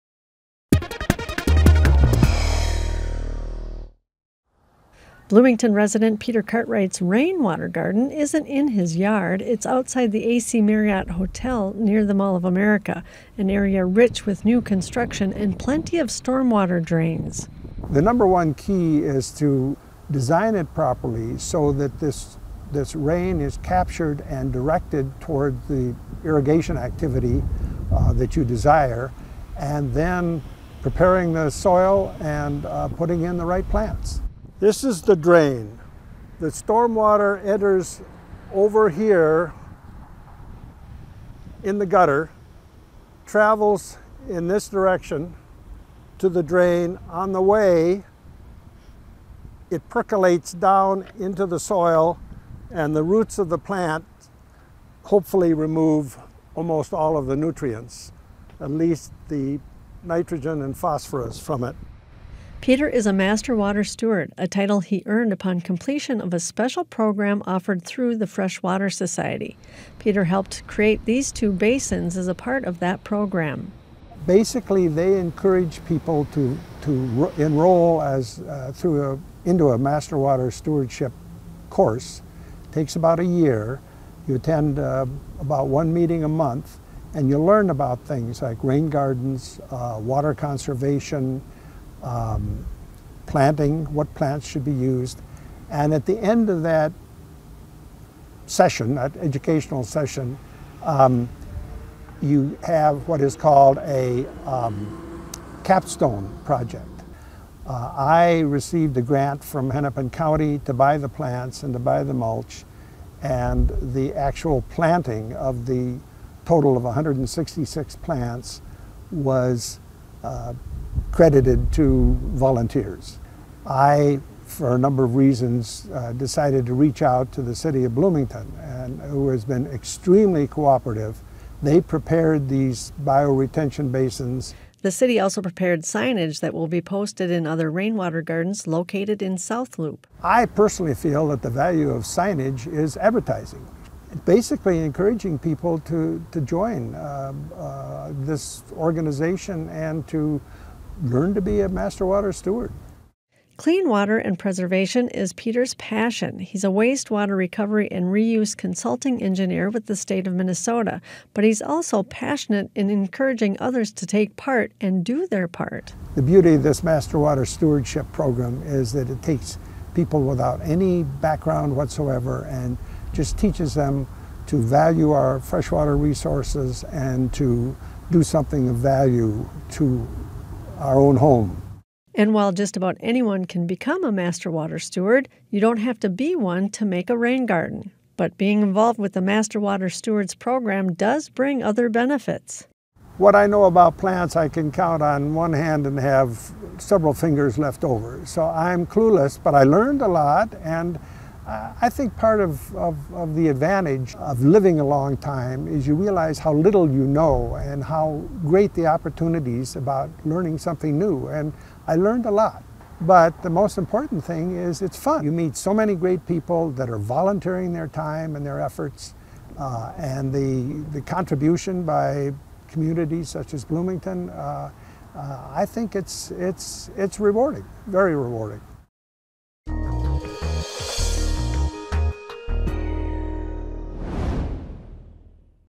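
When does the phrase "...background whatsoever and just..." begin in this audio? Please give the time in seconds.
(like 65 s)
171 s.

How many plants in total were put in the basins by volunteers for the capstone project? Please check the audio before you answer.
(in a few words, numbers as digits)
166.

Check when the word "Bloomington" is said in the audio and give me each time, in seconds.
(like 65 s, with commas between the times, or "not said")
5 s, 127 s, 223 s.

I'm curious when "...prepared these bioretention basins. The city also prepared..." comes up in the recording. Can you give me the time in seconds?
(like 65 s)
131 s.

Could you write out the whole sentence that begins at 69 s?
Peter helped create these two basins as a part of that program.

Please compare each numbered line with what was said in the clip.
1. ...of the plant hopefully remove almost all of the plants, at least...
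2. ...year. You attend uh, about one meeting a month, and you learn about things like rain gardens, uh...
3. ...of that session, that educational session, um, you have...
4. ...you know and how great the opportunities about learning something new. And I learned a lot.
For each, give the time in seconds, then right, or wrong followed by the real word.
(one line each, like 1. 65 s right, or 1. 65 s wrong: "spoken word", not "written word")
1. 53 s wrong: "nutrients", not "plants"
2. 83 s right
3. 96 s right
4. 206 s right.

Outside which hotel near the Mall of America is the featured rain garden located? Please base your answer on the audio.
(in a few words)
AC Marriott Hotel.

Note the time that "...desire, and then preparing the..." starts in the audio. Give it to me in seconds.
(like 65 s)
28 s.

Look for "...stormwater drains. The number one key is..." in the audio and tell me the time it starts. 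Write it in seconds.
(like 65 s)
16 s.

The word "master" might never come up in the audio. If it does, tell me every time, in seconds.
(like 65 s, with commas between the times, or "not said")
63 s, 79 s, 151 s, 166 s, 184 s, 189 s.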